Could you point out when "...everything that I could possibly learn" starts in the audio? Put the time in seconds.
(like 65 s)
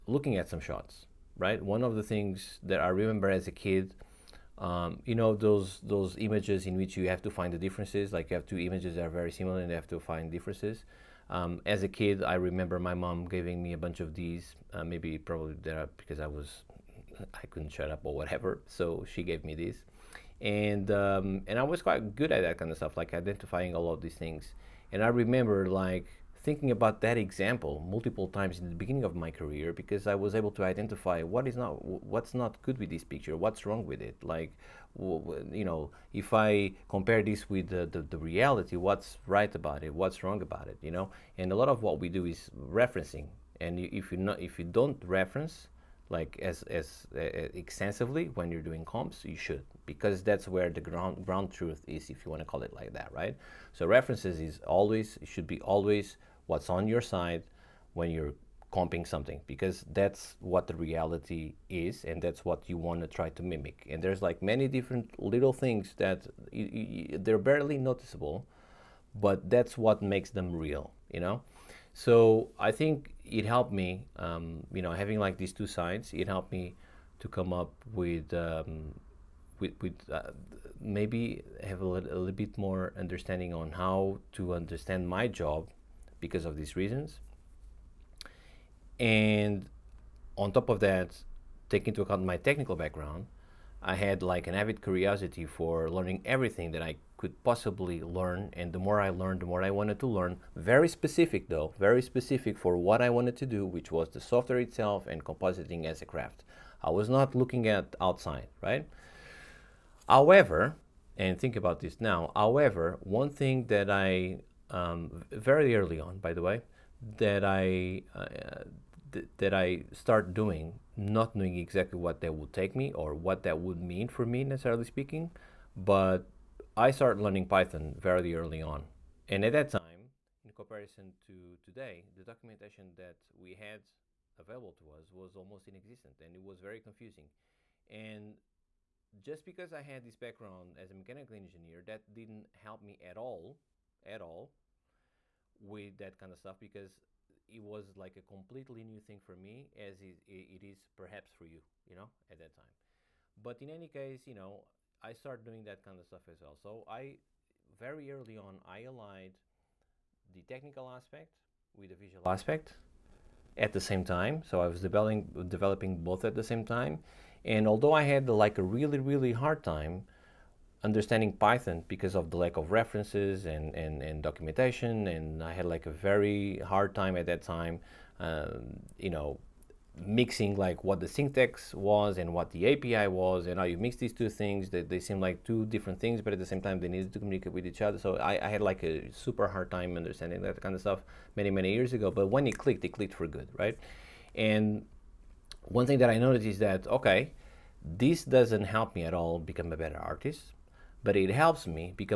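96 s.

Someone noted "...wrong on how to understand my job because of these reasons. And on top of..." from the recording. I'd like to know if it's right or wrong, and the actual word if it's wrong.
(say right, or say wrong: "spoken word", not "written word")
wrong: "understanding", not "wrong".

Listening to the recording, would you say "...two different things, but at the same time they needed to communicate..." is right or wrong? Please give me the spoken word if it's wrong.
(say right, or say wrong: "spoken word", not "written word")
right.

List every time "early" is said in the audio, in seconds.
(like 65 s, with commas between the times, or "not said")
115 s, 128 s, 158 s.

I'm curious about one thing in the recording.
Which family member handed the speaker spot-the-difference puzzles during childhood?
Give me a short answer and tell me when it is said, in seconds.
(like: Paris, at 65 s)
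Mom, at 12 s.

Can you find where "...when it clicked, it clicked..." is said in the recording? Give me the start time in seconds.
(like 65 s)
192 s.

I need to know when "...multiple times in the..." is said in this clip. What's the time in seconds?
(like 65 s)
27 s.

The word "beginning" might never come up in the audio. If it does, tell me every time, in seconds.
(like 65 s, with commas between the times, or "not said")
28 s.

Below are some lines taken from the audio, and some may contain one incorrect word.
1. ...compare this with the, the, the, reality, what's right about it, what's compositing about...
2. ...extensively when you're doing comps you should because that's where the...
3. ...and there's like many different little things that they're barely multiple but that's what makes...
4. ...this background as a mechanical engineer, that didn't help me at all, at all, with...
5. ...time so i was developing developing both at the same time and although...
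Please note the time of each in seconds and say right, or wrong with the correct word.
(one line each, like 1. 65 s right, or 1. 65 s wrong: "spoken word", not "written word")
1. 36 s wrong: "wrong", not "compositing"
2. 47 s right
3. 63 s wrong: "noticeable", not "multiple"
4. 140 s right
5. 164 s right.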